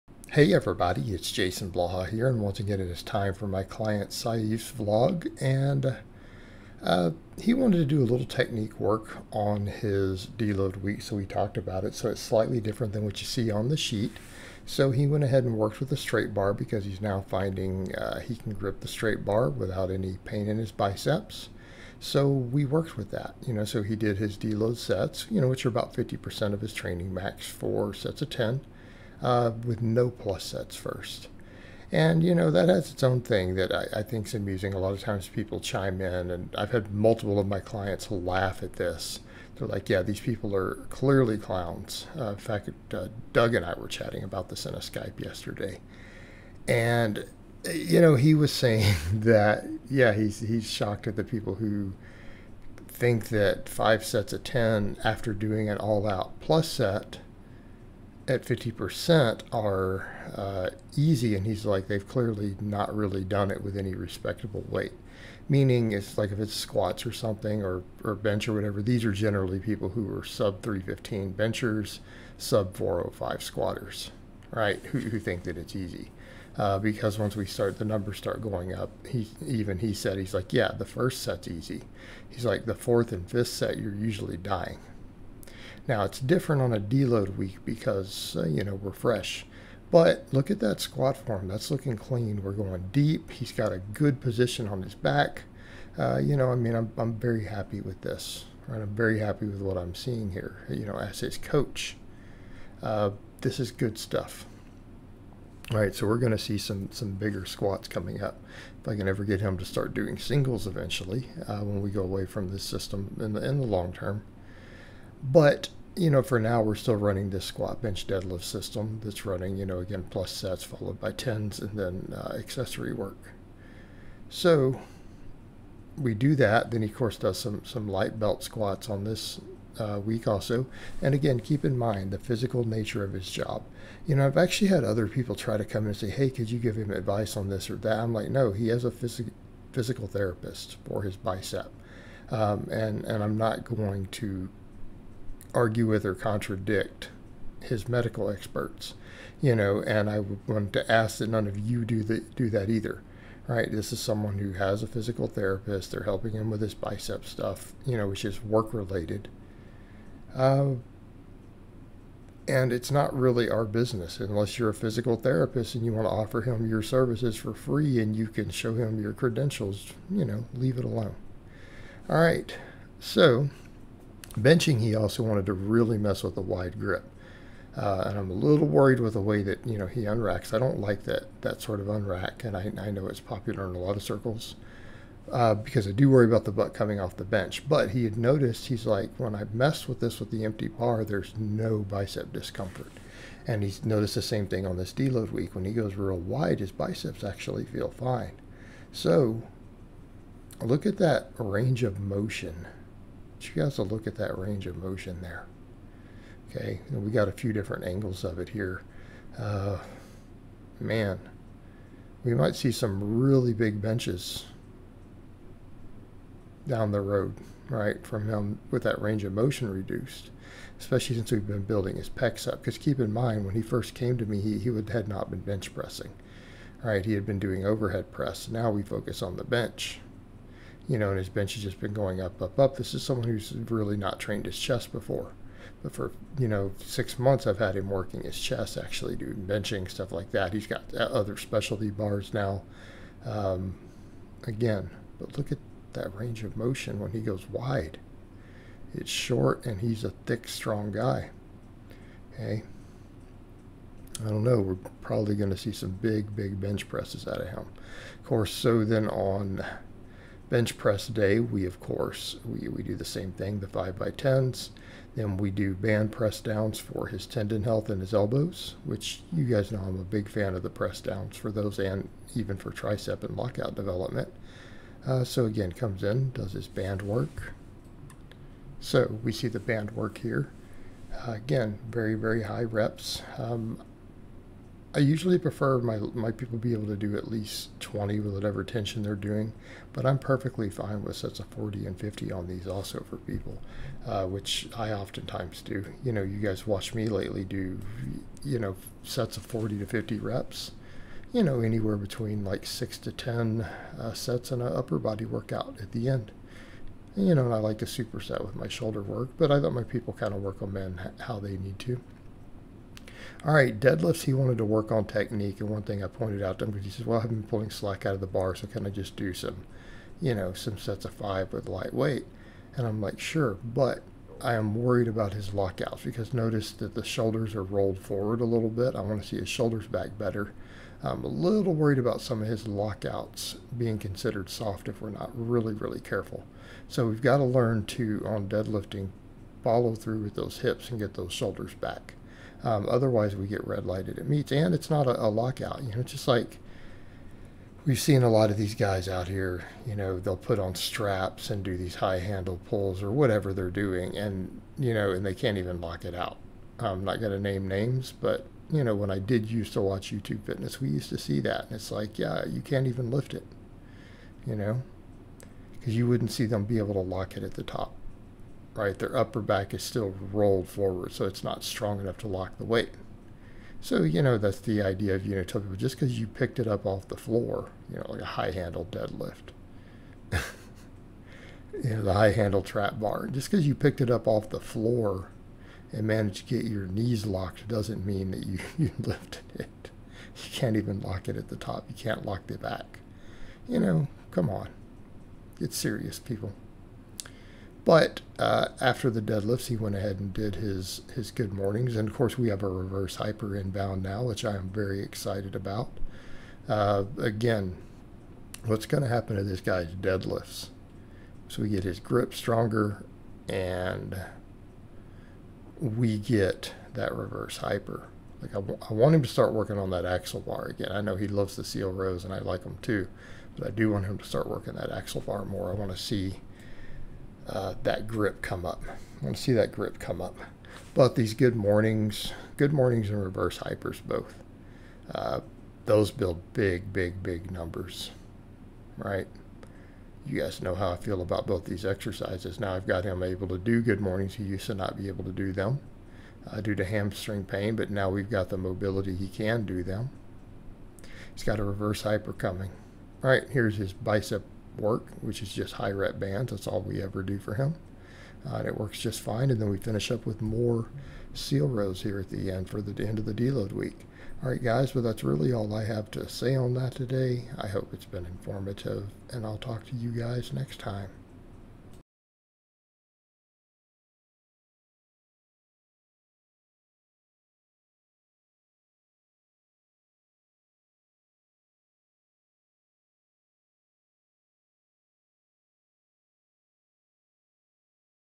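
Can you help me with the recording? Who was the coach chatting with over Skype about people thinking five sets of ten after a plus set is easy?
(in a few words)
Doug.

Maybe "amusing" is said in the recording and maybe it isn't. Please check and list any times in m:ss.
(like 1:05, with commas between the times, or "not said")
0:34.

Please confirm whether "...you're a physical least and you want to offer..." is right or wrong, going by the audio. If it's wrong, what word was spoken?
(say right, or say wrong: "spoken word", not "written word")
wrong: "therapist", not "least".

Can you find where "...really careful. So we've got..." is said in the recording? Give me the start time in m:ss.
5:35.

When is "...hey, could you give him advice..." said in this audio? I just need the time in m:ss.
2:16.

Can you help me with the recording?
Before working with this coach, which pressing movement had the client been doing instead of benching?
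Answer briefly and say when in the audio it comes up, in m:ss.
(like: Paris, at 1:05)
overhead press, at 3:47.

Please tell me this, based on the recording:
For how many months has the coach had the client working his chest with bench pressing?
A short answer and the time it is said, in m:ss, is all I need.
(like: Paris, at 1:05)
six months, at 3:56.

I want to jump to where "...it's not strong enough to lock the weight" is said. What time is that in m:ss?
6:11.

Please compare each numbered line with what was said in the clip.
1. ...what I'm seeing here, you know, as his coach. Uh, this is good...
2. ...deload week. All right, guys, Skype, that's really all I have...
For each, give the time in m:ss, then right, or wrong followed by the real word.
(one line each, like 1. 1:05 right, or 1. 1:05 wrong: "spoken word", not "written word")
1. 1:39 right
2. 7:43 wrong: "Well", not "Skype".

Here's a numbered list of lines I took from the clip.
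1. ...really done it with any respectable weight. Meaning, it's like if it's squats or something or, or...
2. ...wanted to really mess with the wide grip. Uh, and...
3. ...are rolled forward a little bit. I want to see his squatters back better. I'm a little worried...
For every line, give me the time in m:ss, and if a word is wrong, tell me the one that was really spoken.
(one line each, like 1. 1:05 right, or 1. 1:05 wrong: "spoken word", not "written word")
1. 1:02 right
2. 2:55 right
3. 5:27 wrong: "shoulders", not "squatters".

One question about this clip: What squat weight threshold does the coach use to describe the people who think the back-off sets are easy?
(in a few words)
405.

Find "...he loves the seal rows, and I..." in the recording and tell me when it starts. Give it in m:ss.
7:01.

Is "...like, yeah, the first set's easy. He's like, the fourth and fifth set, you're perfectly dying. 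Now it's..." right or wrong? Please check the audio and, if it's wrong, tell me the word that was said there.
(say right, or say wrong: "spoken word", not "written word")
wrong: "usually", not "perfectly".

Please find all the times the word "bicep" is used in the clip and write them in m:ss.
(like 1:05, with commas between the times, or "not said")
0:20, 2:21, 2:36, 3:11, 3:16, 7:33.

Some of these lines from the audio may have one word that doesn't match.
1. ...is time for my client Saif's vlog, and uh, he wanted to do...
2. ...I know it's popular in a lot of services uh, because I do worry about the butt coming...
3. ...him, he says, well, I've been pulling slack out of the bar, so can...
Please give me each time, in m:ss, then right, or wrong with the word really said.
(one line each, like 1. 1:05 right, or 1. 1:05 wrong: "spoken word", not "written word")
1. 0:02 right
2. 3:02 wrong: "circles", not "services"
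3. 5:16 right.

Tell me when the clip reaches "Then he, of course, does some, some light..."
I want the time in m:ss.
2:06.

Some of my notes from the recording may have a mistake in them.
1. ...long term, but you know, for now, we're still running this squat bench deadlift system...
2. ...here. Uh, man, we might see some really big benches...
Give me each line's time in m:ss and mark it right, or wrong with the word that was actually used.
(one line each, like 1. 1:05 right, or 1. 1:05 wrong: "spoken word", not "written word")
1. 1:53 right
2. 3:28 right.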